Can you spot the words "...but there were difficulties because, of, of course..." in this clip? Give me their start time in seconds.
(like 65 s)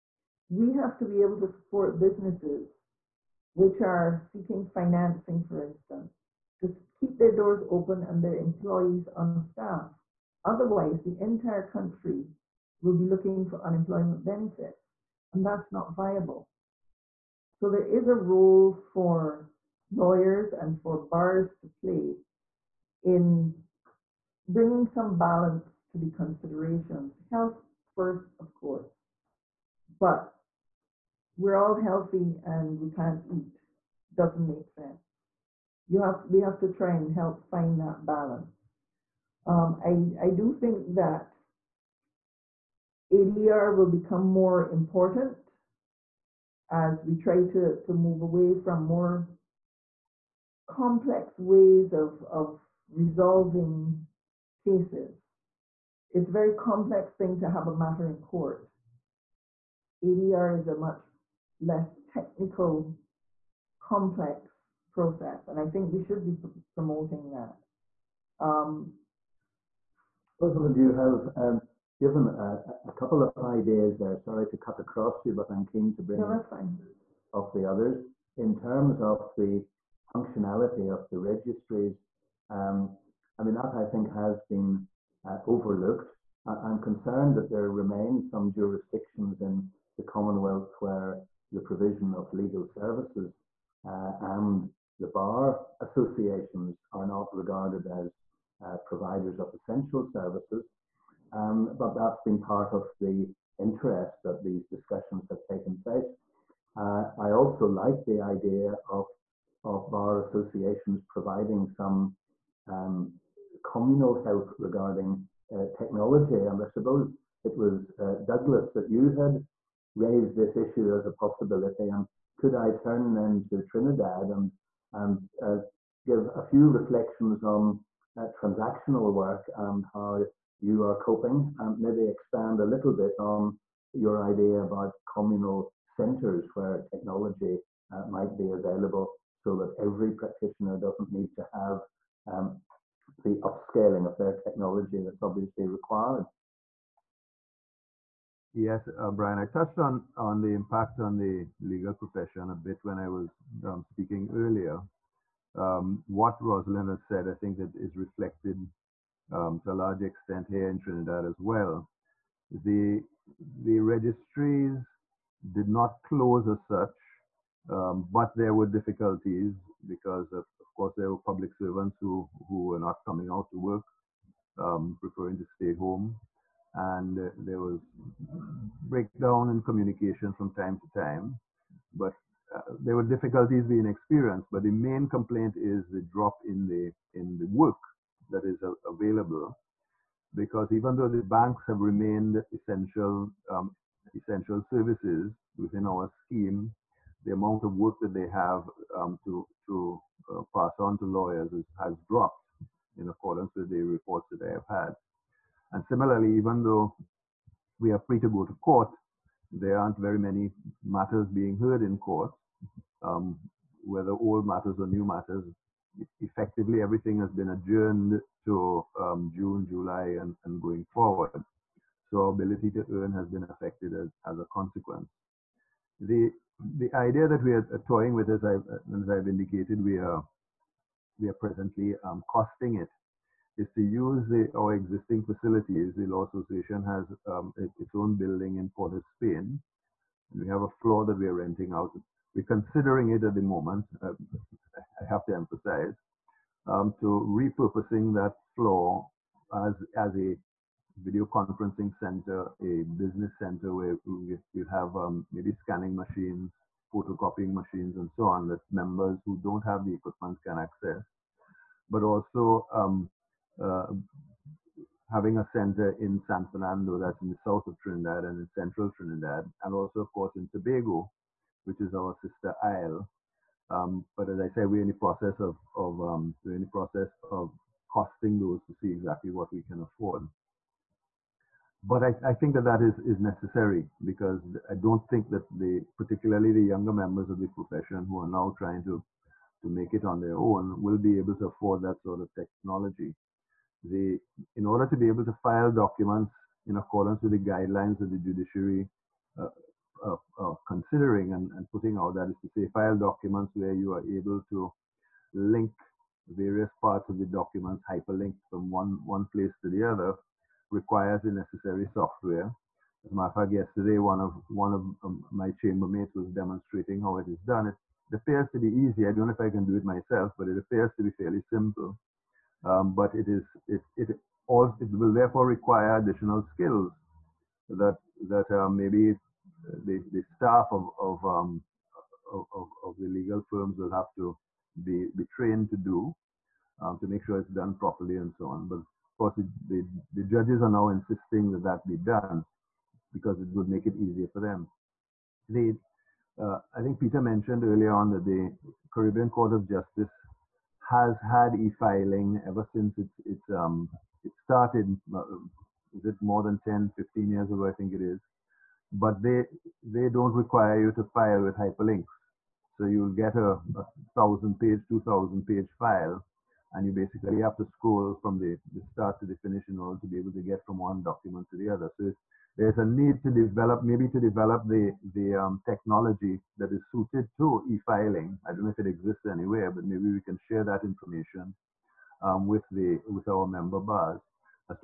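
168 s.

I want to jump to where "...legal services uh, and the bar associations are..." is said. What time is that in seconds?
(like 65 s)
92 s.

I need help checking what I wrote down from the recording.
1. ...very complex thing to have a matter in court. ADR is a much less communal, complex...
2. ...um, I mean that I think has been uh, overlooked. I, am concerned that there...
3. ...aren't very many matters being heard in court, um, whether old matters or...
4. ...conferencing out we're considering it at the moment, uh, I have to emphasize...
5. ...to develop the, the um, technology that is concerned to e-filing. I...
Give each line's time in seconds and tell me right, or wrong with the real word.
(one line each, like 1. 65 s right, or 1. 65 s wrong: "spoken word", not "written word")
1. 56 s wrong: "technical", not "communal"
2. 82 s right
3. 209 s right
4. 241 s wrong: "renting", not "conferencing"
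5. 374 s wrong: "suited", not "concerned".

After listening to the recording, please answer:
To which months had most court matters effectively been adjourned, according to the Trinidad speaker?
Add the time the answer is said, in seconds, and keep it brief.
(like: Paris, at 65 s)
June, July, at 219 s.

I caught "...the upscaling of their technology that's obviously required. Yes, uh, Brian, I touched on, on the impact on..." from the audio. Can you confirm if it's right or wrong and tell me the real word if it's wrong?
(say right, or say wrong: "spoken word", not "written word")
right.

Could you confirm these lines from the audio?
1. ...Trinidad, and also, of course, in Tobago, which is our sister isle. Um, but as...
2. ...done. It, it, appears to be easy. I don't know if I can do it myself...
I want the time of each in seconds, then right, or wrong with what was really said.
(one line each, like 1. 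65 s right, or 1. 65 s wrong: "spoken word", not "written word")
1. 268 s right
2. 317 s right.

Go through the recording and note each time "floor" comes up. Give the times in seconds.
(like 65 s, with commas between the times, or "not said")
240 s, 248 s.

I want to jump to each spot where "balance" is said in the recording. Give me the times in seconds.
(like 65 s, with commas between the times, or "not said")
25 s, 38 s.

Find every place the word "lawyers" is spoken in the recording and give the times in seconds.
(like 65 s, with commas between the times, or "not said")
19 s, 201 s.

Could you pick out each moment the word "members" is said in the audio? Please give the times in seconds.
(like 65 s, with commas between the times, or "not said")
258 s, 286 s, 383 s.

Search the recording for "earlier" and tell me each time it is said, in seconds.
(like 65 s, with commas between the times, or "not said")
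154 s, 347 s.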